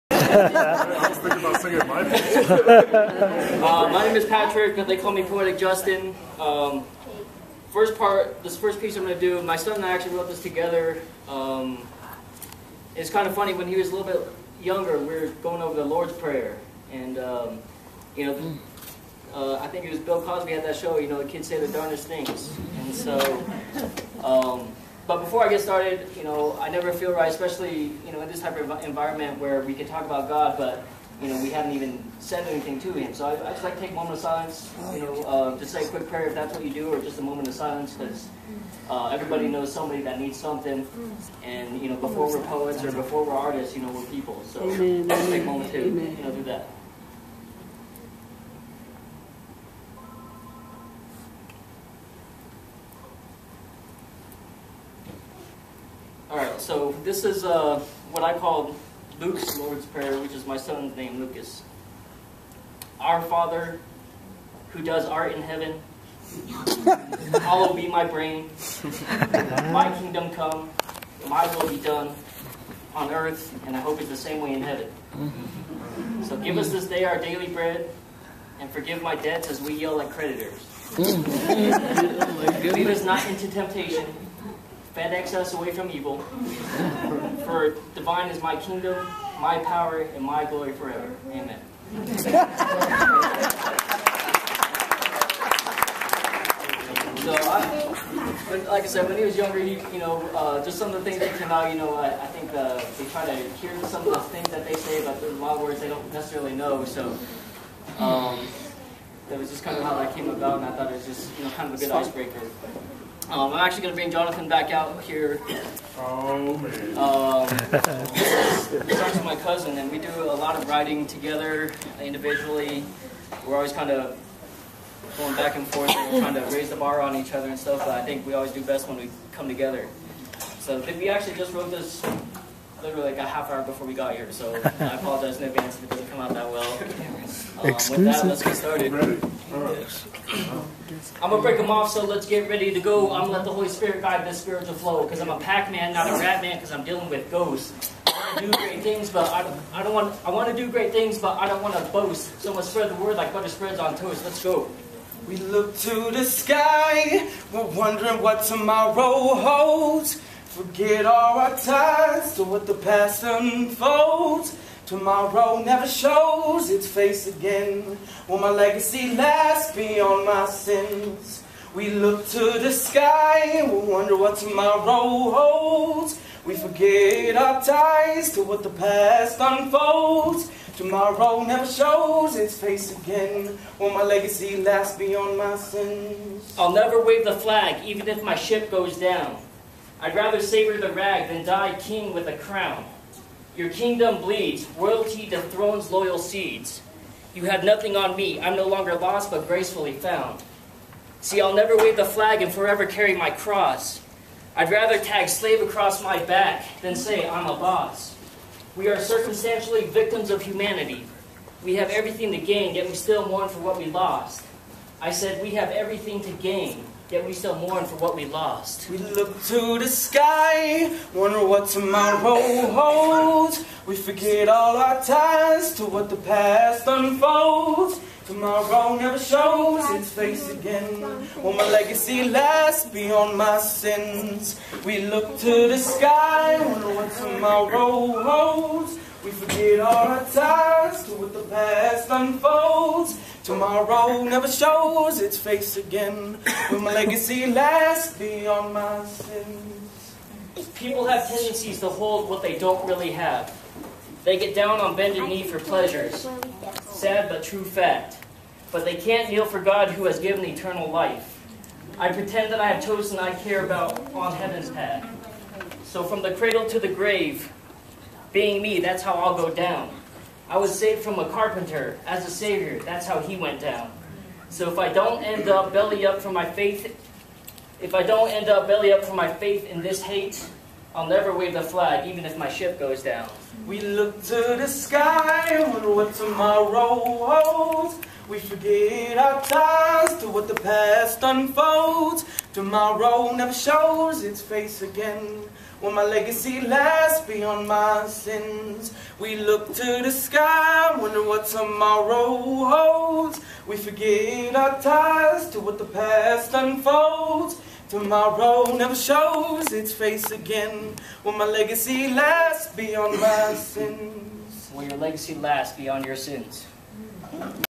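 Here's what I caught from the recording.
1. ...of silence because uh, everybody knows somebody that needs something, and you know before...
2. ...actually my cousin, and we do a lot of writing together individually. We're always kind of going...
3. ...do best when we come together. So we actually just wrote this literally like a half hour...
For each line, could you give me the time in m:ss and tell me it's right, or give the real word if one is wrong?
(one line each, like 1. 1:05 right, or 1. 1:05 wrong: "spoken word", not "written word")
1. 0:37 right
2. 1:58 right
3. 2:08 right.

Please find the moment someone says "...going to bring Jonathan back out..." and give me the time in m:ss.
1:53.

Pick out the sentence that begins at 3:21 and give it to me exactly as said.
See, I'll never wave the flag and forever carry my cross.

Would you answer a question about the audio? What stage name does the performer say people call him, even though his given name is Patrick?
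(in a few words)
Poetic Justin.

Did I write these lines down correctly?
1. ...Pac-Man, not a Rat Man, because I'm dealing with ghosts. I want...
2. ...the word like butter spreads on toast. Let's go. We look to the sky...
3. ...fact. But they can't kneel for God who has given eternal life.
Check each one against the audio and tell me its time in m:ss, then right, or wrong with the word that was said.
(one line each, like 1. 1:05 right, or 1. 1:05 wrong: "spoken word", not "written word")
1. 2:25 right
2. 2:32 right
3. 4:17 right.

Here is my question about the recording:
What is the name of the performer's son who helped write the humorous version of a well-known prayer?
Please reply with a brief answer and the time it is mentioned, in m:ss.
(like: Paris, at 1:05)
Lucas, at 1:01.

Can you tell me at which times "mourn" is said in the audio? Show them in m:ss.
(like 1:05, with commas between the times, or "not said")
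3:33, 3:37.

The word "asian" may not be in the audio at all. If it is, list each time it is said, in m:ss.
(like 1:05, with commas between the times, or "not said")
not said.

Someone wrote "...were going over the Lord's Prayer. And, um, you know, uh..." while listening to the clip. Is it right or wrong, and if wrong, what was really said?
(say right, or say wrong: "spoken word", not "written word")
right.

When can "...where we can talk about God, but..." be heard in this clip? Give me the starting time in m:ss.
0:29.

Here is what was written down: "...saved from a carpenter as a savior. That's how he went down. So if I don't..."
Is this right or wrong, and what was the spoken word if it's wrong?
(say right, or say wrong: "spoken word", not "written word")
right.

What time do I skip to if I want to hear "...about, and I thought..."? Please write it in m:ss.
1:50.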